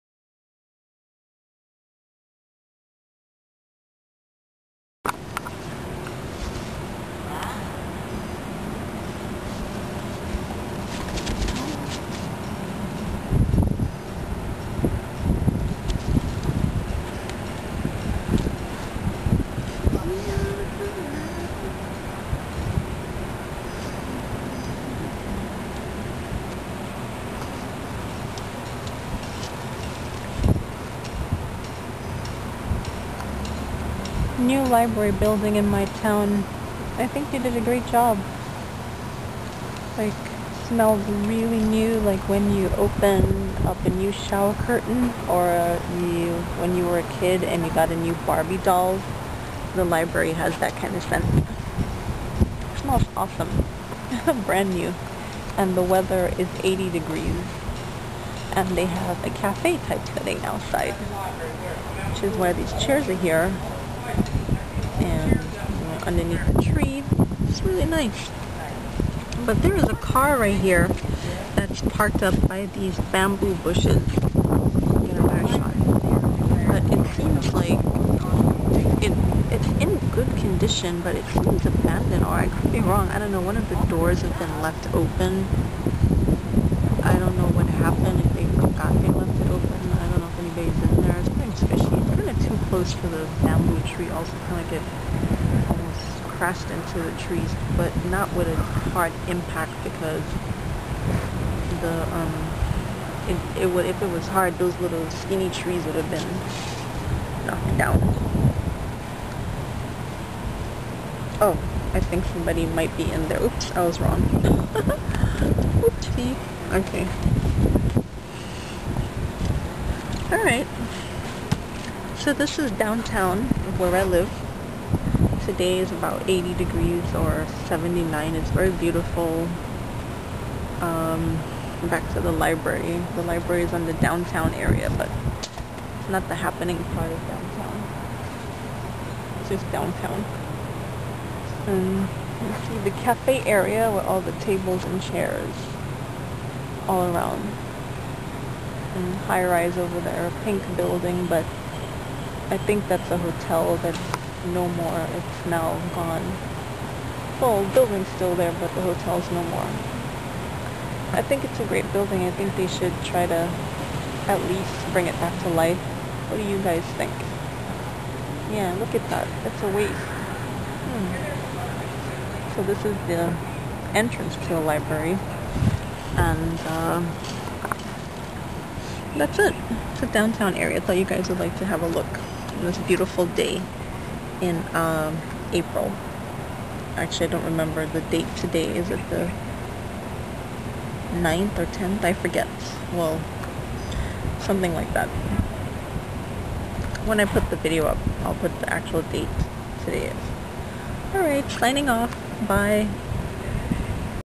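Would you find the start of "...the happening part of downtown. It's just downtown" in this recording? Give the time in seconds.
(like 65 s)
136 s.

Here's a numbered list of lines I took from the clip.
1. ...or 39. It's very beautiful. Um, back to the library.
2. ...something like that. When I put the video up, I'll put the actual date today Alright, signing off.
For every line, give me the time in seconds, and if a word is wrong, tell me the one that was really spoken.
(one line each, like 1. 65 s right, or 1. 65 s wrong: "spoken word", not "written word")
1. 127 s wrong: "79", not "39"
2. 194 s right.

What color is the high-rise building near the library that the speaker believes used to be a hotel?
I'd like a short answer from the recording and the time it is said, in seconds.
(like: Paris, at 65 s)
pink, at 150 s.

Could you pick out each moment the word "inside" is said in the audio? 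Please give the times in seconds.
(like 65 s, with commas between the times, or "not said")
not said.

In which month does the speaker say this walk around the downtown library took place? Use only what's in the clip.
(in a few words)
April.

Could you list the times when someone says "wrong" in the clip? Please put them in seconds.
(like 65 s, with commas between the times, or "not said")
82 s, 113 s.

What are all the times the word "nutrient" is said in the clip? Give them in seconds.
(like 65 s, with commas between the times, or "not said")
not said.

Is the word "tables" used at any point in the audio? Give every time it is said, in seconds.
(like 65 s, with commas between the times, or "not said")
144 s.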